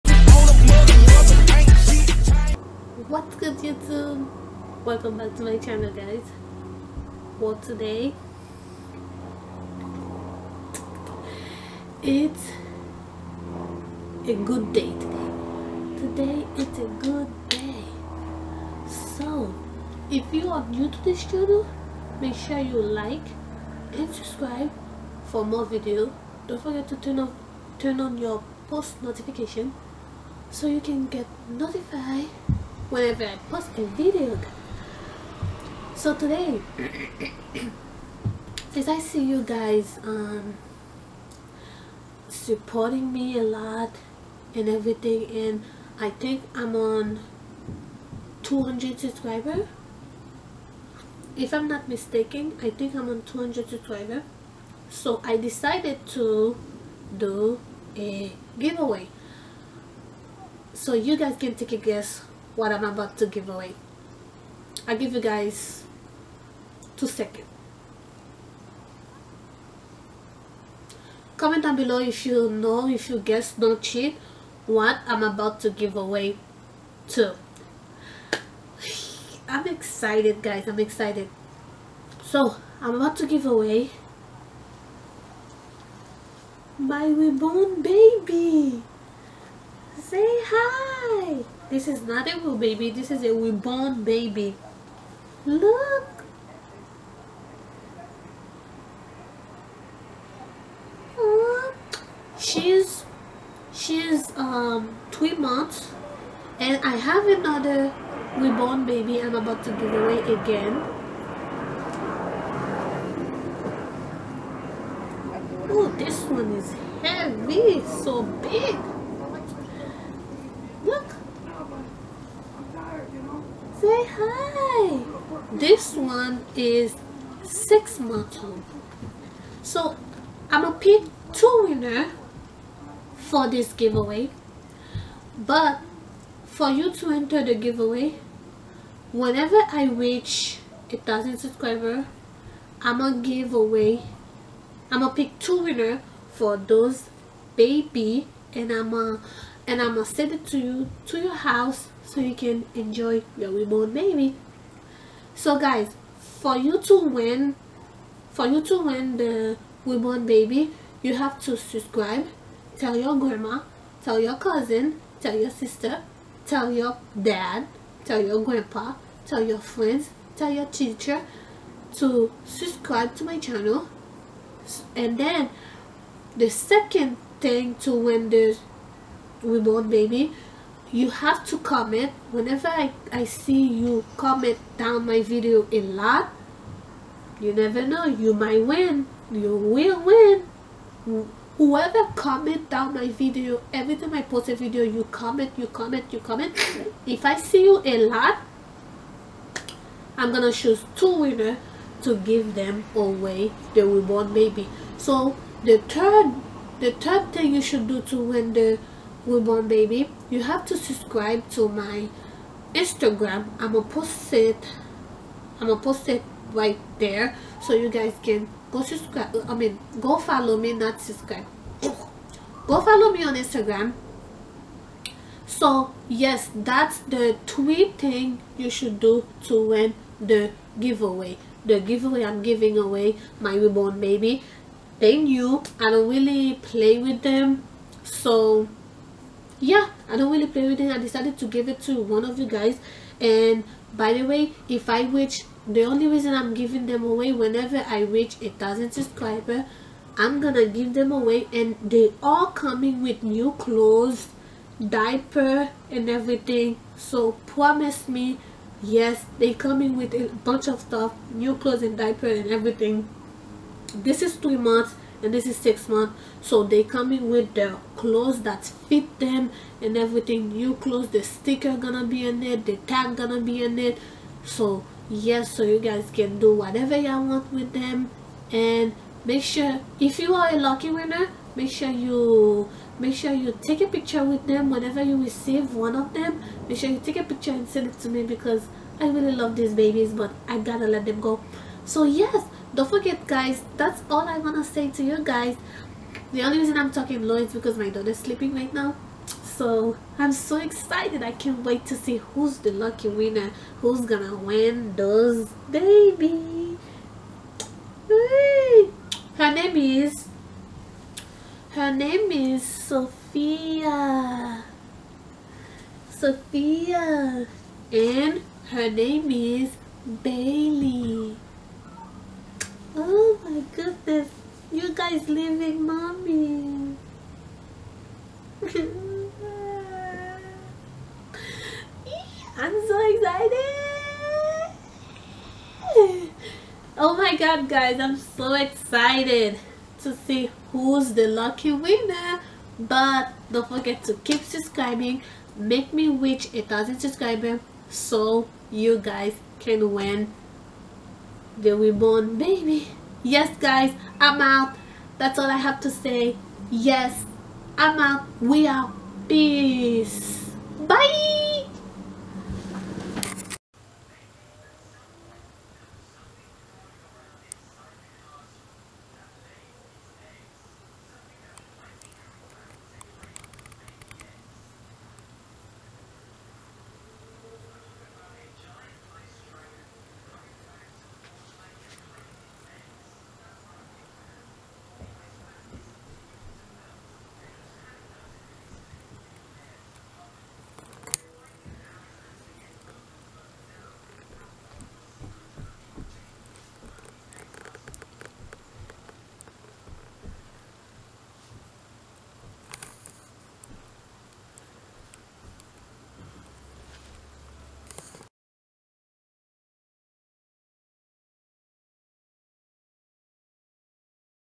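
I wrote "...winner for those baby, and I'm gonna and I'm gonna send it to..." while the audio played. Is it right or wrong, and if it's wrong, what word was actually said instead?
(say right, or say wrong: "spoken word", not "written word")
right.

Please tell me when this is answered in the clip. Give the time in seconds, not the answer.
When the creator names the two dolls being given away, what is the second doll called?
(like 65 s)
320 s.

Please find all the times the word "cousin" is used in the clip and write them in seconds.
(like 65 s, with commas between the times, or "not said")
164 s.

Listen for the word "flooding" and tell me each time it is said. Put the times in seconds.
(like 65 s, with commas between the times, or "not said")
not said.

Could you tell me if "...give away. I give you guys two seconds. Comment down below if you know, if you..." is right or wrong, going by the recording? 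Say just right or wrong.
right.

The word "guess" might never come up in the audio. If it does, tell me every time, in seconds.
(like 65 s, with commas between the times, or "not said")
61 s, 73 s.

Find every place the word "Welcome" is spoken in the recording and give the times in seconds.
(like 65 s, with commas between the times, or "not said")
4 s.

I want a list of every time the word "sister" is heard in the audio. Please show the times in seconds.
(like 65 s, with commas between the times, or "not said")
165 s.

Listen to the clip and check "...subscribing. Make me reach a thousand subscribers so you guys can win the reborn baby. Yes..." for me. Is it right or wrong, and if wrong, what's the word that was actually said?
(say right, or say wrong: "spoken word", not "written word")
right.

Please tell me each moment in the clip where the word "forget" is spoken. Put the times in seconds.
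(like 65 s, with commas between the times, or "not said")
26 s, 292 s, 343 s.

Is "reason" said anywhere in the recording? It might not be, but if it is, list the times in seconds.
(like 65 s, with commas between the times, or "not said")
246 s, 296 s.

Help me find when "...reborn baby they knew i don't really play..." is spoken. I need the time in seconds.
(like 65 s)
233 s.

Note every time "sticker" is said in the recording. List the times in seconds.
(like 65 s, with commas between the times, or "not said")
271 s.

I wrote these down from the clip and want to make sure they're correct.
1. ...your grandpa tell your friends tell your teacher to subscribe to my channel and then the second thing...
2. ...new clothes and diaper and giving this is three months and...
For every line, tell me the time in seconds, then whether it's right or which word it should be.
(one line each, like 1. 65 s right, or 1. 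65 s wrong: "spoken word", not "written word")
1. 168 s right
2. 261 s wrong: "everything", not "giving".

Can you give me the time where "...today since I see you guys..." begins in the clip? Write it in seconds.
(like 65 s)
36 s.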